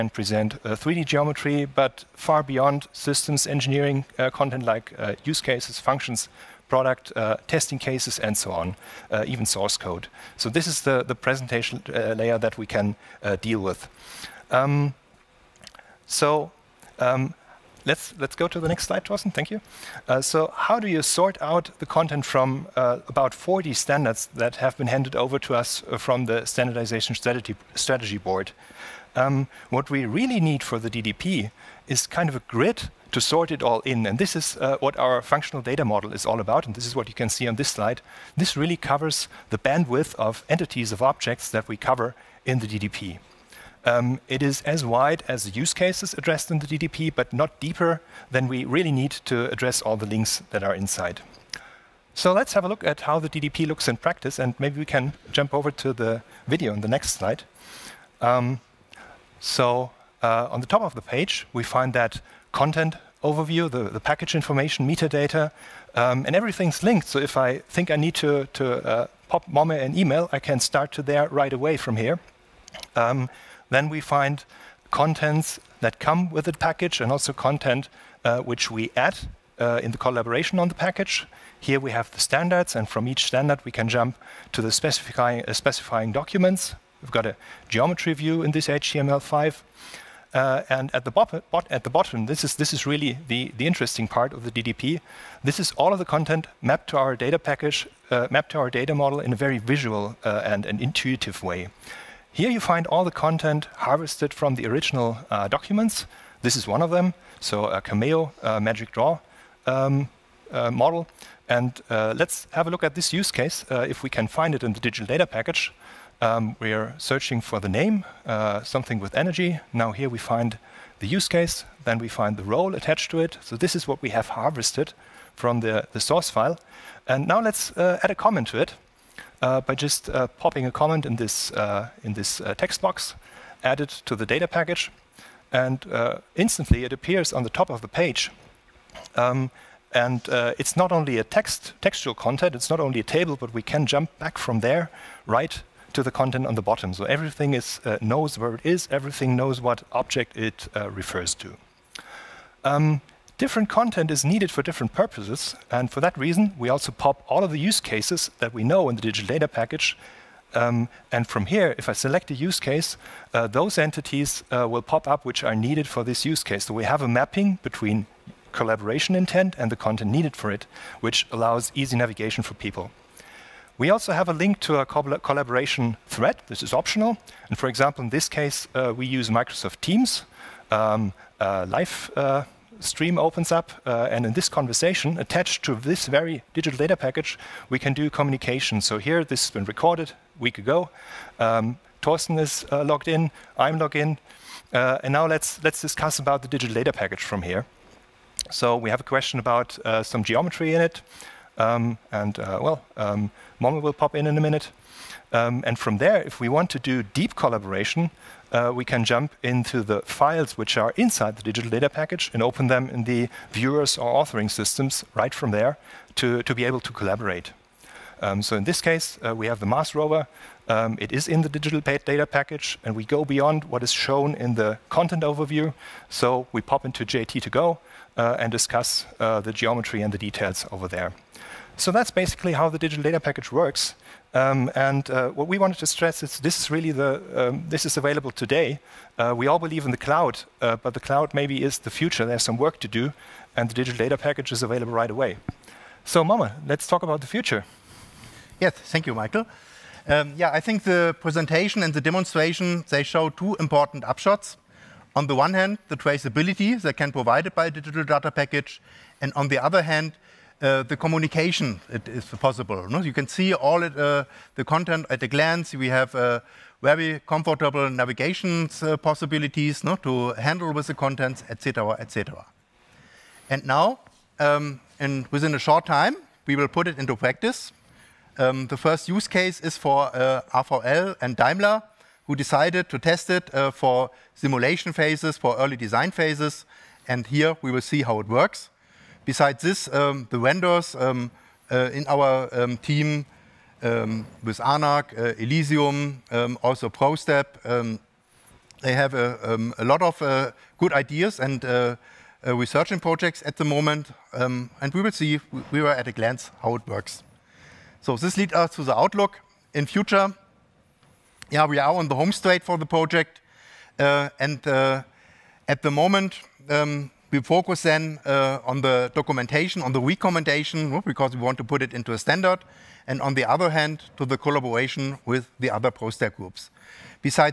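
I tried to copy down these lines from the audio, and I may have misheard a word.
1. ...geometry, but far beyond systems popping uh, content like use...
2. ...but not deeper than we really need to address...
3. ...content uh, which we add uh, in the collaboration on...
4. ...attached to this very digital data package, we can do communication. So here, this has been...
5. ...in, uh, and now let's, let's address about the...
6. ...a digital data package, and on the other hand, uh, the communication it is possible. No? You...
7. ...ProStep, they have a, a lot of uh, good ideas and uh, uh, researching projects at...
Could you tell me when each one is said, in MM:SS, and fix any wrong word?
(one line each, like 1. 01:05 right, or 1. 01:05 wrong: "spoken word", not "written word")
1. 00:01 wrong: "engineering", not "popping"
2. 00:47 right
3. 01:17 right
4. 03:05 right
5. 03:13 wrong: "discuss", not "address"
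6. 04:17 right
7. 04:56 right.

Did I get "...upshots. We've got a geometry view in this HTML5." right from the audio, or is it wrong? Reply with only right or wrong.
wrong.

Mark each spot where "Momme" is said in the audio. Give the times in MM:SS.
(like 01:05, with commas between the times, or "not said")
01:09, 03:23, 04:06.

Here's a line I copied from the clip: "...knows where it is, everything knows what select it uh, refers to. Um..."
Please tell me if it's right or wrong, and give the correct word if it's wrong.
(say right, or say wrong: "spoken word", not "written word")
wrong: "object", not "select".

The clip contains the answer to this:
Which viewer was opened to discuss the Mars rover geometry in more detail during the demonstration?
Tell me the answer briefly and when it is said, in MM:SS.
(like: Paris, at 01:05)
JT2Go, at 03:47.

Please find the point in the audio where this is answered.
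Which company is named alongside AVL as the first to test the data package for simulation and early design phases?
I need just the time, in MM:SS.
04:41.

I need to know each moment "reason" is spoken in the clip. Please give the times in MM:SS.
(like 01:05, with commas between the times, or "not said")
02:36.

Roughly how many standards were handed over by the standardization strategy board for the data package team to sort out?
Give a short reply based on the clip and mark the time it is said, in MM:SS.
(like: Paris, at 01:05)
40, at 00:23.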